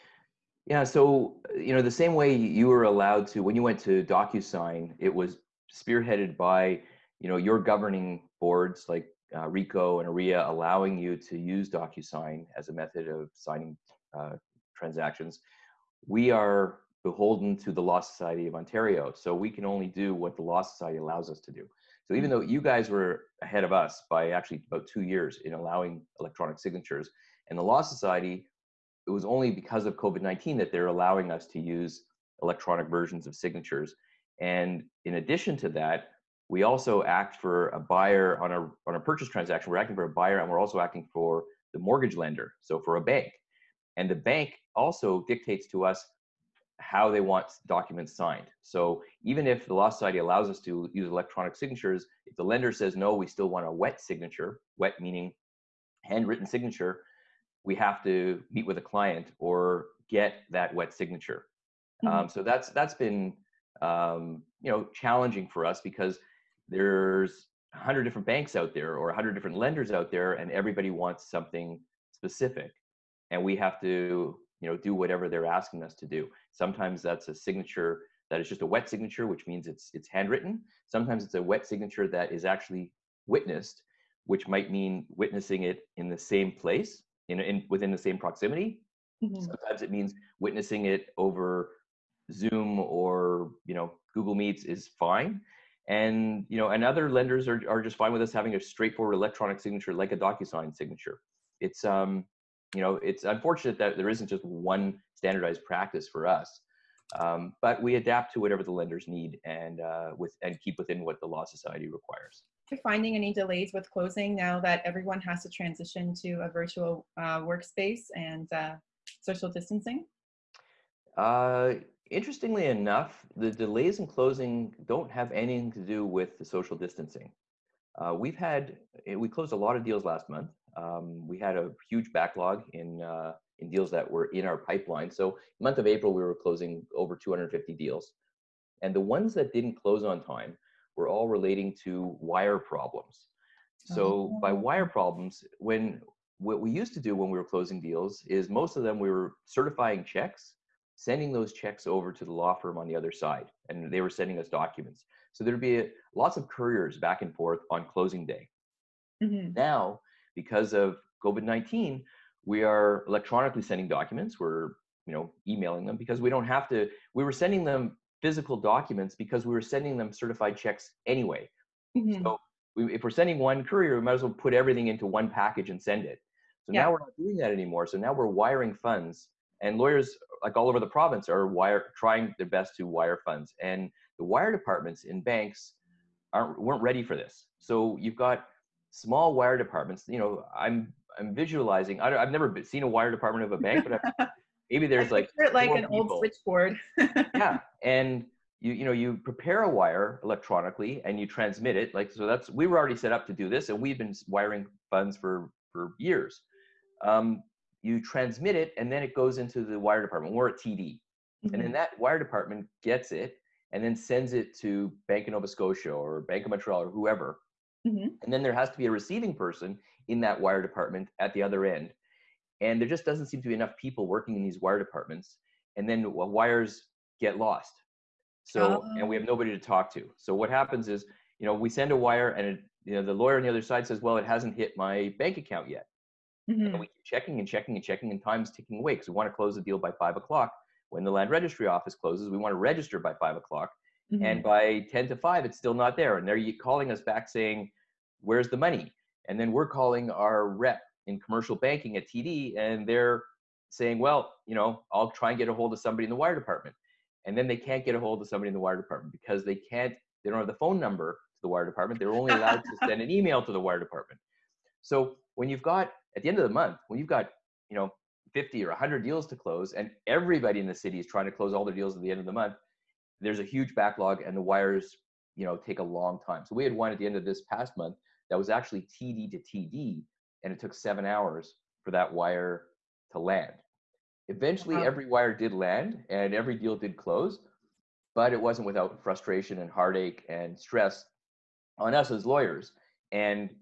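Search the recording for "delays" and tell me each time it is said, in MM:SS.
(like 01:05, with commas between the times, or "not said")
01:53, 02:03.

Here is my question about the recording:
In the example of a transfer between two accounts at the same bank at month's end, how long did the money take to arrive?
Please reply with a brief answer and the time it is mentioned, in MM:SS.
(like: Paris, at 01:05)
7 hours, at 04:40.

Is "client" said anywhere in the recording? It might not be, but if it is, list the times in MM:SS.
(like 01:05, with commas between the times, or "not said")
00:58.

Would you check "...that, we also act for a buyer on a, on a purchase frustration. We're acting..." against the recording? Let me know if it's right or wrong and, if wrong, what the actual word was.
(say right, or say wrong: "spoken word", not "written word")
wrong: "transaction", not "frustration".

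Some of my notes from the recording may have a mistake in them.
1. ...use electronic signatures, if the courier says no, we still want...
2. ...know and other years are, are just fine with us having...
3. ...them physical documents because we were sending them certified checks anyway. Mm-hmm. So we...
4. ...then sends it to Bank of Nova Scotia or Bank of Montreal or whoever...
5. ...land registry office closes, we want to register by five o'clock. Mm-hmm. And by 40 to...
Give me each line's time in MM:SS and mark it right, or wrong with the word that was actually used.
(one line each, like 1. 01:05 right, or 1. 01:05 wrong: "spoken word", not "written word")
1. 00:50 wrong: "lender", not "courier"
2. 01:36 wrong: "lenders", not "years"
3. 02:47 right
4. 03:33 right
5. 04:01 wrong: "10", not "40".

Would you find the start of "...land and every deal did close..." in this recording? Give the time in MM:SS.
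04:45.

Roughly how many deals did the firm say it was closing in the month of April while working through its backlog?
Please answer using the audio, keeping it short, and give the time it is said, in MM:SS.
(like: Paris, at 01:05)
over 250, at 02:16.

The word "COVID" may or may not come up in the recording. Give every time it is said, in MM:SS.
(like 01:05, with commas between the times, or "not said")
00:29, 02:41.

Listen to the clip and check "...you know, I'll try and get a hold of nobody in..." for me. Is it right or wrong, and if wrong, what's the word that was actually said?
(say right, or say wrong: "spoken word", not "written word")
wrong: "somebody", not "nobody".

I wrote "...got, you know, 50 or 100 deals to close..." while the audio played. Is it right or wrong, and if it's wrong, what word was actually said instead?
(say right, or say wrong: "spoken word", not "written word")
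right.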